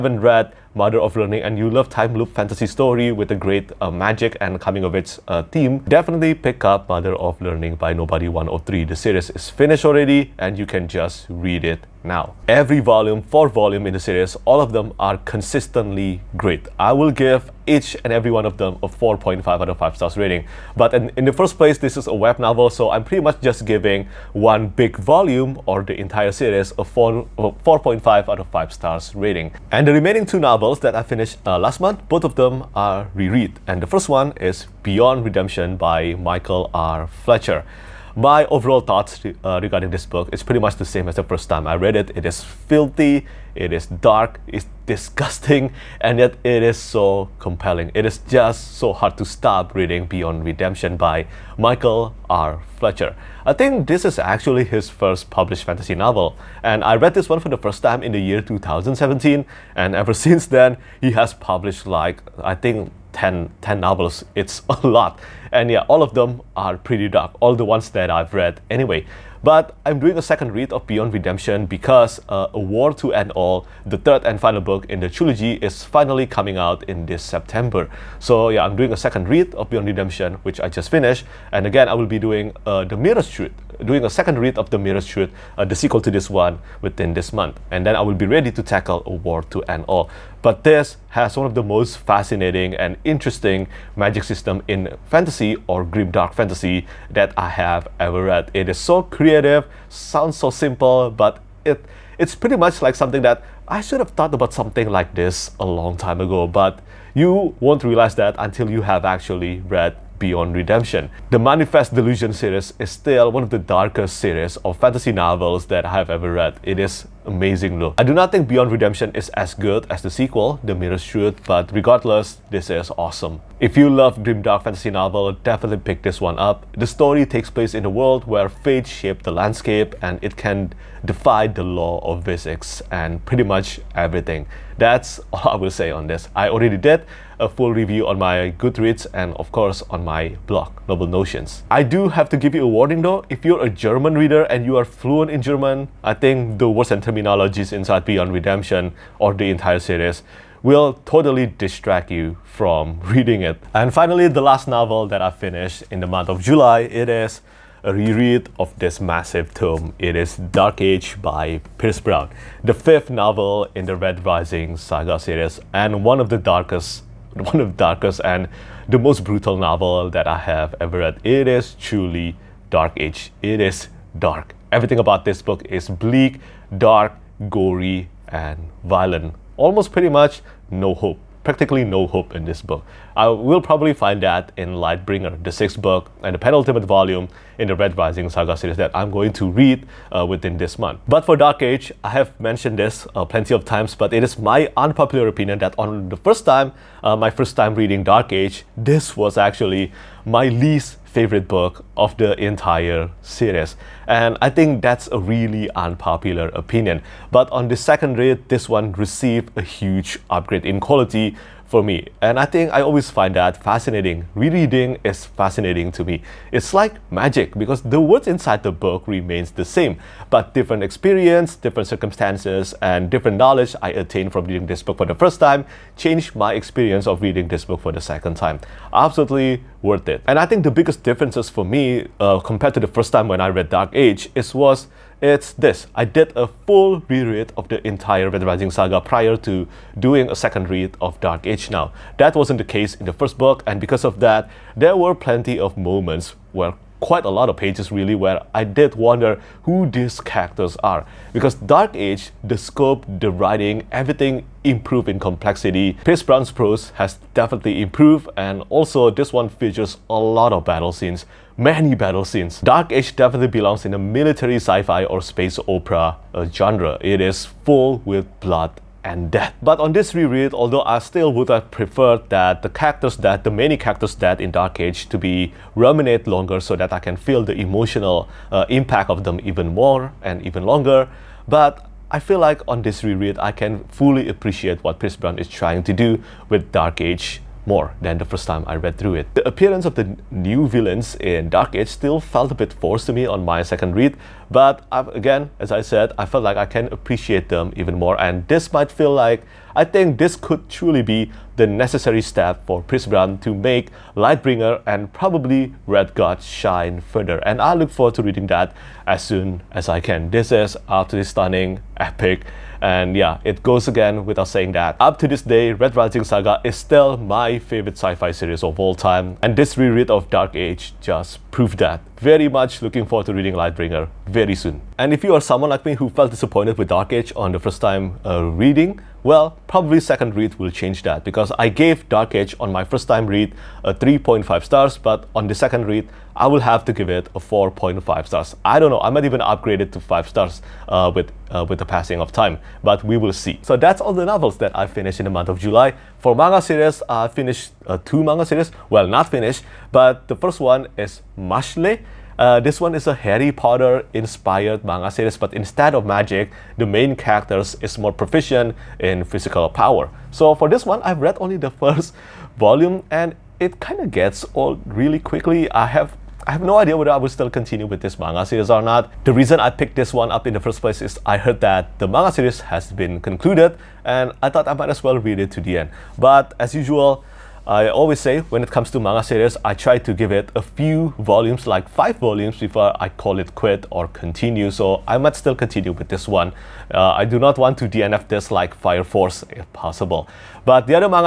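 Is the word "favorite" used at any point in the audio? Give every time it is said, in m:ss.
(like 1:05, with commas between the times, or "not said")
3:21, 5:17.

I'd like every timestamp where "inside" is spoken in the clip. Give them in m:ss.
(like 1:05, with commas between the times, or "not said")
2:27, 3:38.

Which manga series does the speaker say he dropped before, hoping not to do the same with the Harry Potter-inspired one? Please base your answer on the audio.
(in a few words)
Fire Force.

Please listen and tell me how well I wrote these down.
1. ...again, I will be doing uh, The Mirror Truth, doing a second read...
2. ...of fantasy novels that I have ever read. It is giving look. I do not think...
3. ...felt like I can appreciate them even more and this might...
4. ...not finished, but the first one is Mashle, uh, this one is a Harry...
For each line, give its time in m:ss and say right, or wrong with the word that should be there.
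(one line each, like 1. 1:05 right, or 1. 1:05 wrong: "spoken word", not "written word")
1. 1:21 right
2. 1:54 wrong: "amazing", not "giving"
3. 4:56 right
4. 5:49 right.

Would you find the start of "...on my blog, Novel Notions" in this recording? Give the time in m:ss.
2:19.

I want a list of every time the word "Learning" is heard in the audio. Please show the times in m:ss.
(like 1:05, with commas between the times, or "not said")
0:01, 0:07.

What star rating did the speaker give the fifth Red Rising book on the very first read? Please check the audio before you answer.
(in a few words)
3.5 stars.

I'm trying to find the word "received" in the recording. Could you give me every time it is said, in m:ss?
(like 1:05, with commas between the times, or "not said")
3:28.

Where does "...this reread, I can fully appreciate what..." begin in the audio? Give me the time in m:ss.
4:42.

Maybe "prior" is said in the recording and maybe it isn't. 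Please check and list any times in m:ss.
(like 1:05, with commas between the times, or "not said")
3:58.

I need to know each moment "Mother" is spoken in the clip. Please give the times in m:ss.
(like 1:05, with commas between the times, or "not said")
0:00, 0:06.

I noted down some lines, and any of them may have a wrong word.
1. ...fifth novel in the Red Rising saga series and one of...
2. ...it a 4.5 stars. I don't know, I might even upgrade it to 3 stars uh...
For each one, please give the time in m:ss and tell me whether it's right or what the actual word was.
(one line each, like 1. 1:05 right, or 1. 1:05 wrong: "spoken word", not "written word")
1. 2:42 right
2. 5:37 wrong: "5", not "3".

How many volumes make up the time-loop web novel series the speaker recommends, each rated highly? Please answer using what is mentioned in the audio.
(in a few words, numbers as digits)
4.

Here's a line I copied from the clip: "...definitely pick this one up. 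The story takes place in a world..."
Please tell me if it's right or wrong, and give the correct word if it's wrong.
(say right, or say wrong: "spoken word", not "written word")
right.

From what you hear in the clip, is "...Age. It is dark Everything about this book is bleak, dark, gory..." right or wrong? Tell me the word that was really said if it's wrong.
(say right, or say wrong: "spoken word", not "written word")
right.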